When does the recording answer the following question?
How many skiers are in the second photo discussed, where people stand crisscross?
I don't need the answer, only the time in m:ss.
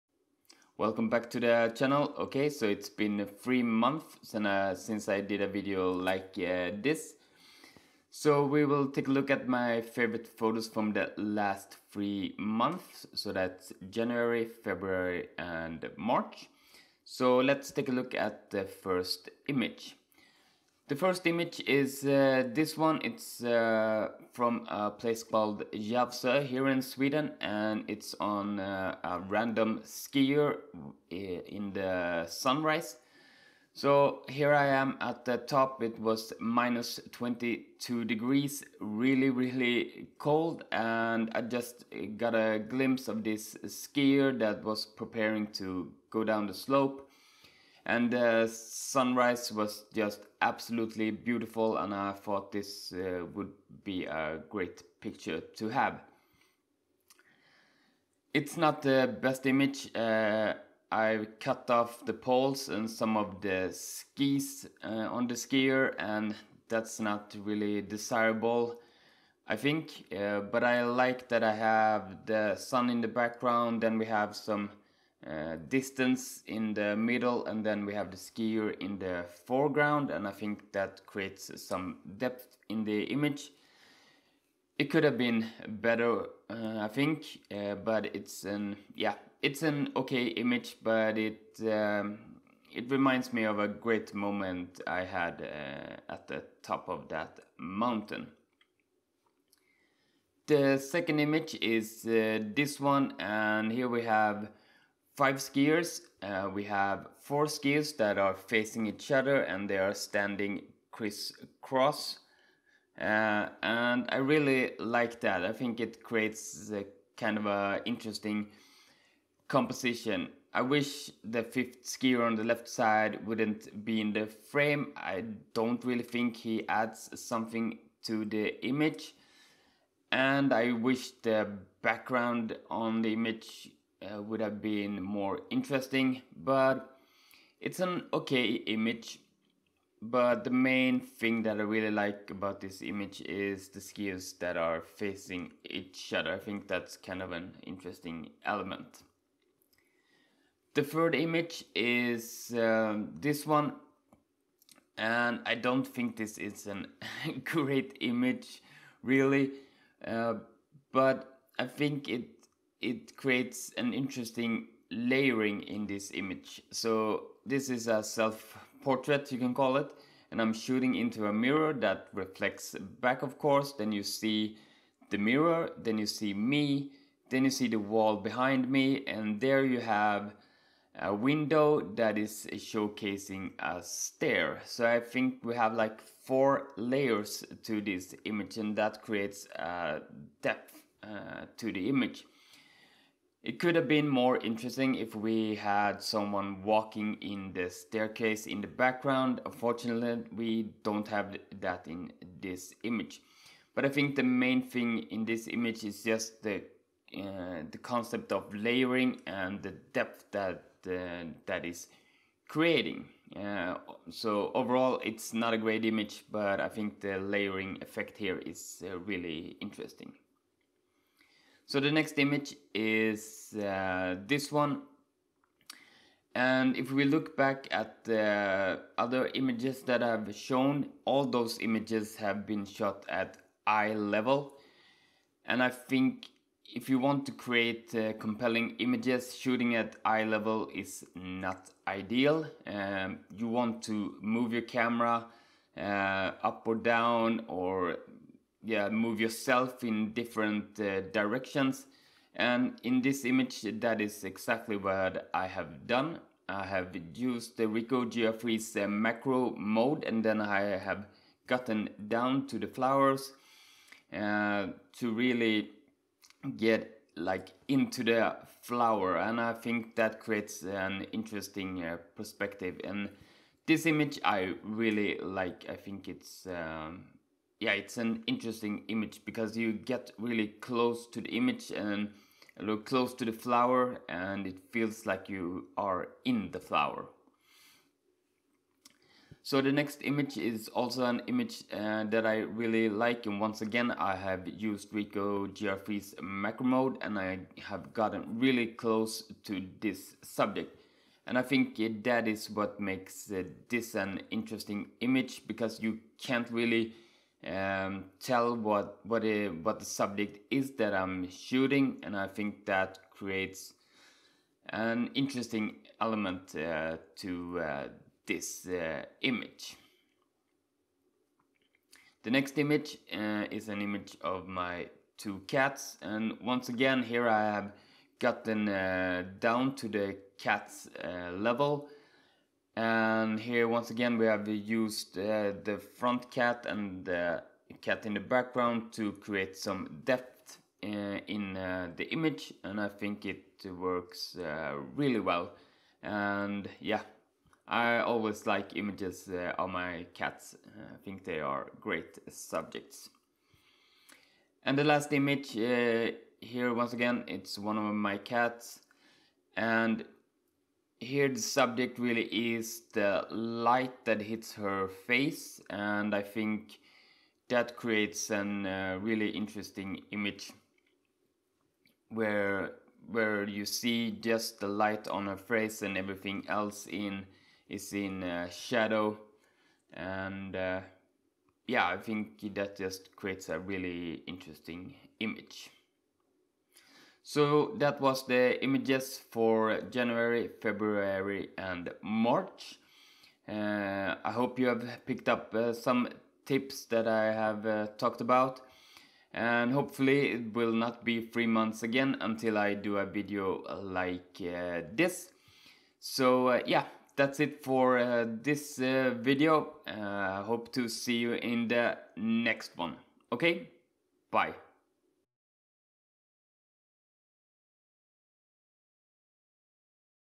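1:45.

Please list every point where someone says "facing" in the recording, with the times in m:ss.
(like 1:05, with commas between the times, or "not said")
1:48, 2:24.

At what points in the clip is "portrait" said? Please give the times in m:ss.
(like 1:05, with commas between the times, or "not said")
2:48.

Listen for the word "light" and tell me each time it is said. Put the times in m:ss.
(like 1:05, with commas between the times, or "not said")
6:03, 6:14.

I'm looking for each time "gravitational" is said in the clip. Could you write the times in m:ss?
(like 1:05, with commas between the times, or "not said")
not said.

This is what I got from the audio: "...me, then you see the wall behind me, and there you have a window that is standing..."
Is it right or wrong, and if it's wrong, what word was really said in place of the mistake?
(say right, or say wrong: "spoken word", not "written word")
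wrong: "showcasing", not "standing".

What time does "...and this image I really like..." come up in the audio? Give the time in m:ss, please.
4:32.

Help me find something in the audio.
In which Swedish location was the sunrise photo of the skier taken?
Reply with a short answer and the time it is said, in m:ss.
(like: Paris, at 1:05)
Järvsö, at 0:25.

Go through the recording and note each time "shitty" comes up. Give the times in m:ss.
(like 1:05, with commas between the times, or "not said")
not said.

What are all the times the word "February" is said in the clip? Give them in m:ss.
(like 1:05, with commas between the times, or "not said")
0:14, 6:30.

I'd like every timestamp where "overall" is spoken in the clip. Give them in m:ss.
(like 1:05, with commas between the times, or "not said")
3:34.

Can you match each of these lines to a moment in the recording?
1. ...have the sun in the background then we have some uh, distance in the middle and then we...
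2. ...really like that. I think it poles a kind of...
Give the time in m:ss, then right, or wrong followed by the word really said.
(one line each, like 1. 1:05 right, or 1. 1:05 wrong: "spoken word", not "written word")
1. 1:11 right
2. 1:54 wrong: "creates", not "poles".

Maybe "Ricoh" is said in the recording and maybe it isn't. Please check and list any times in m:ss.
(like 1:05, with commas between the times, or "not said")
4:17, 4:54.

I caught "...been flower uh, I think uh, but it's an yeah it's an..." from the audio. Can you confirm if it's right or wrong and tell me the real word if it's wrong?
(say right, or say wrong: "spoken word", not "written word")
wrong: "better", not "flower".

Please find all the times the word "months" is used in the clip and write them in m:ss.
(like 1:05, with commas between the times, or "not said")
0:03, 0:12, 6:41.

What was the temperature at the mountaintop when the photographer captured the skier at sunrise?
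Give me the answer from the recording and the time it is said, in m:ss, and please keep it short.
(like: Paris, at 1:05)
-22 degrees, at 0:36.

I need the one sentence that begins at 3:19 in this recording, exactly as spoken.
Unfortunately, we don't have that in this image.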